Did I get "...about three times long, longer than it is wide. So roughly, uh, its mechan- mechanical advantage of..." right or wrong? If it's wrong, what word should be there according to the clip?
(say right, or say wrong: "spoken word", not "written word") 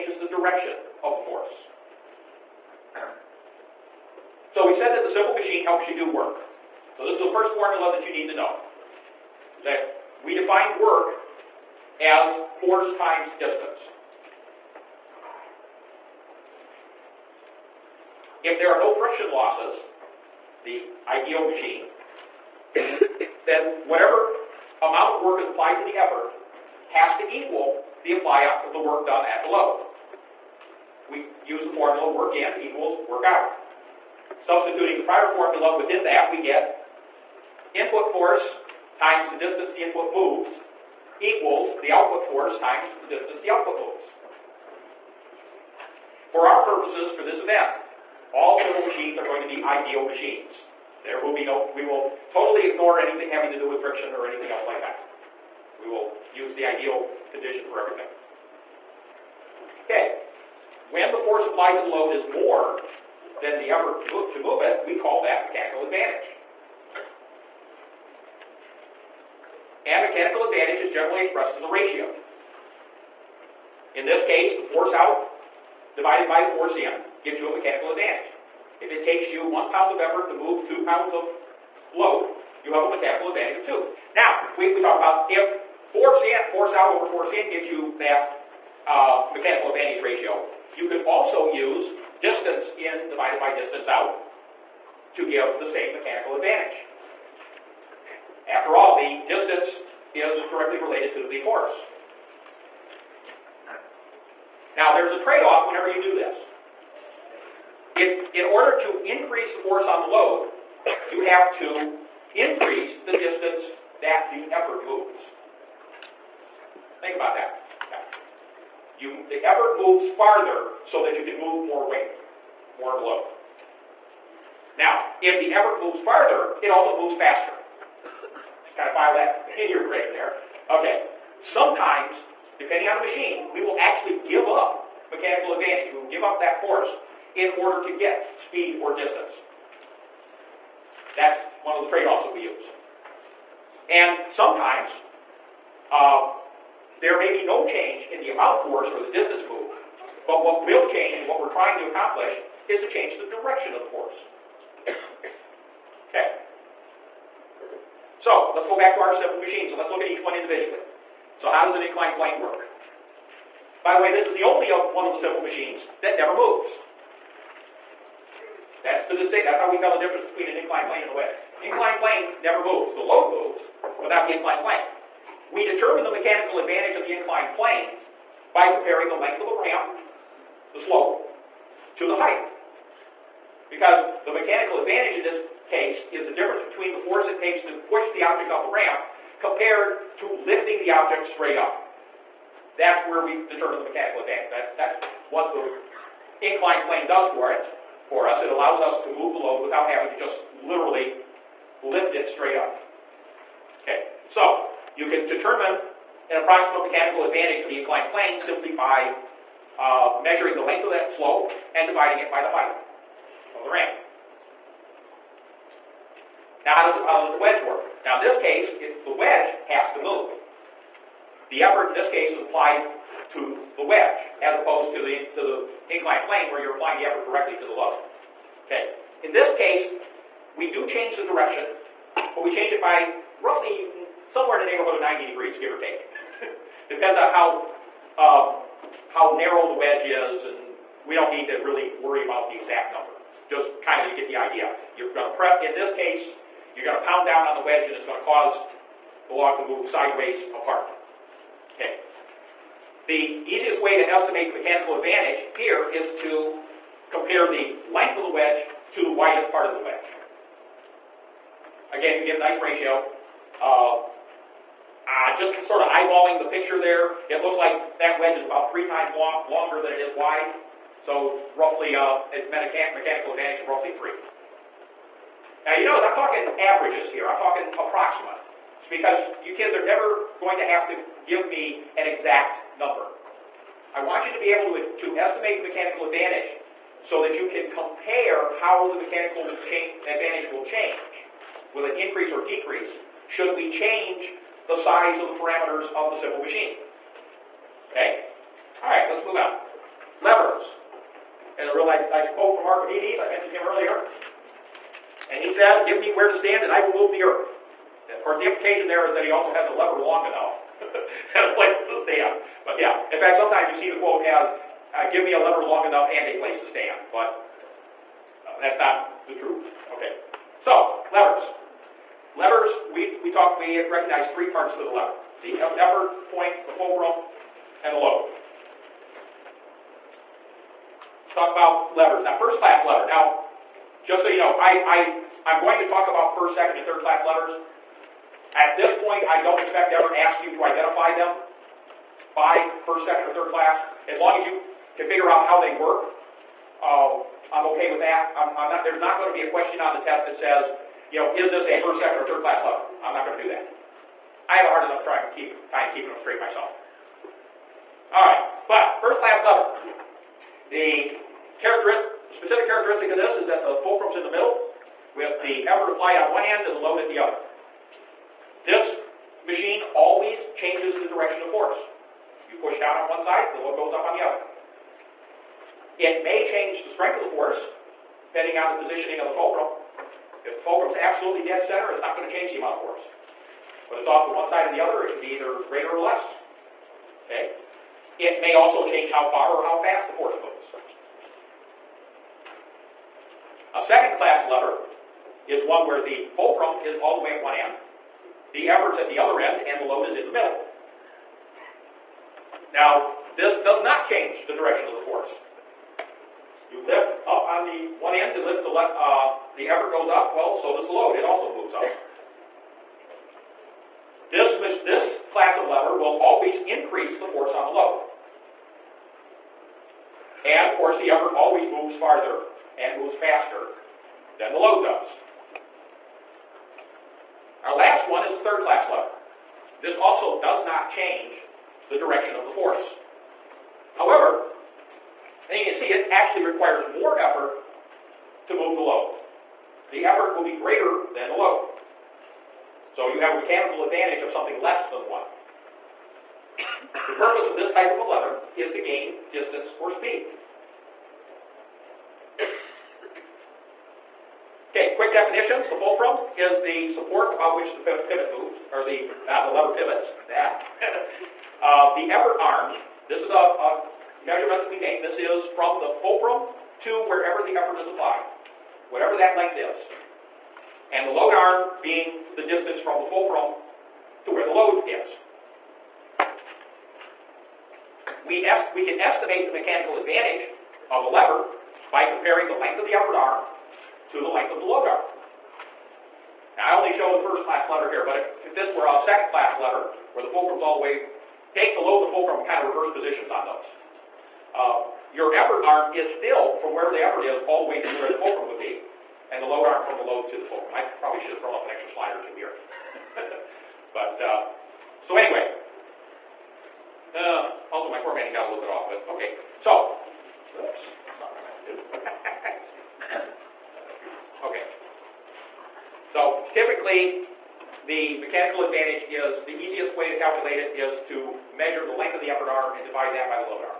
right.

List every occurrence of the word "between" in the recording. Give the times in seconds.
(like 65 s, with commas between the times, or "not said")
170 s, 186 s.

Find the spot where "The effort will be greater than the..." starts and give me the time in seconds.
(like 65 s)
439 s.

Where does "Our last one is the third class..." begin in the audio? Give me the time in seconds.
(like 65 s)
427 s.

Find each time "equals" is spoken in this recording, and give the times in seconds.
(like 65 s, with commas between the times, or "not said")
27 s, 32 s, 41 s.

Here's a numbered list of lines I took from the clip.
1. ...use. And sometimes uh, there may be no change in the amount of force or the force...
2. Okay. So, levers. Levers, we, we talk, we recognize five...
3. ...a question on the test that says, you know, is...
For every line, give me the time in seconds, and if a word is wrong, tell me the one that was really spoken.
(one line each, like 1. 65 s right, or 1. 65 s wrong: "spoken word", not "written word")
1. 142 s wrong: "distance", not "force"
2. 319 s wrong: "three", not "five"
3. 349 s right.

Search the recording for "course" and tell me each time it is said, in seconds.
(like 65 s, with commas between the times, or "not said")
308 s, 420 s.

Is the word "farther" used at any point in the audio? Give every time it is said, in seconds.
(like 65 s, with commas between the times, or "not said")
120 s, 126 s, 421 s.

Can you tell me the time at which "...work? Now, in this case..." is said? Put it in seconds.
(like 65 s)
217 s.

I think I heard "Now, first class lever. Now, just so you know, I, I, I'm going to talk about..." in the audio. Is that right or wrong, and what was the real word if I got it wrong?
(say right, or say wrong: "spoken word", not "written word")
right.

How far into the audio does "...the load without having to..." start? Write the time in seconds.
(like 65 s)
199 s.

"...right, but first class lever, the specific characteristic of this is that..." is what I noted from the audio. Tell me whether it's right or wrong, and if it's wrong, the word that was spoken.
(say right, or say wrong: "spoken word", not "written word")
right.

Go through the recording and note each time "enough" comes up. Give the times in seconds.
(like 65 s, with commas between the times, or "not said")
310 s, 315 s, 354 s.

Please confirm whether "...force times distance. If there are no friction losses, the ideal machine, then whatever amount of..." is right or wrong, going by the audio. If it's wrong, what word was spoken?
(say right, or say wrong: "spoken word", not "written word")
right.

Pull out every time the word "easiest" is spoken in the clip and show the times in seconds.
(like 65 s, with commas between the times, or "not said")
253 s, 519 s.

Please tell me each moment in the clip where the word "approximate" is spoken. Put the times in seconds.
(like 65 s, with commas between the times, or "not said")
206 s, 277 s.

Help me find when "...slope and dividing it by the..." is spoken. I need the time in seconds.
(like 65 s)
211 s.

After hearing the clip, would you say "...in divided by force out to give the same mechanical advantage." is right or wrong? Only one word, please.
wrong.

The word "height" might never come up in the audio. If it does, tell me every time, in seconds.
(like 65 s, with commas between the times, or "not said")
182 s, 212 s.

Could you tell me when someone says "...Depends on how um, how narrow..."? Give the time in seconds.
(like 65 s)
236 s.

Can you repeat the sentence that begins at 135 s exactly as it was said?
We will give up that force in order to get speed or distance.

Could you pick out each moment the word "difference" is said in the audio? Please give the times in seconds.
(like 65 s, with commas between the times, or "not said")
170 s, 186 s.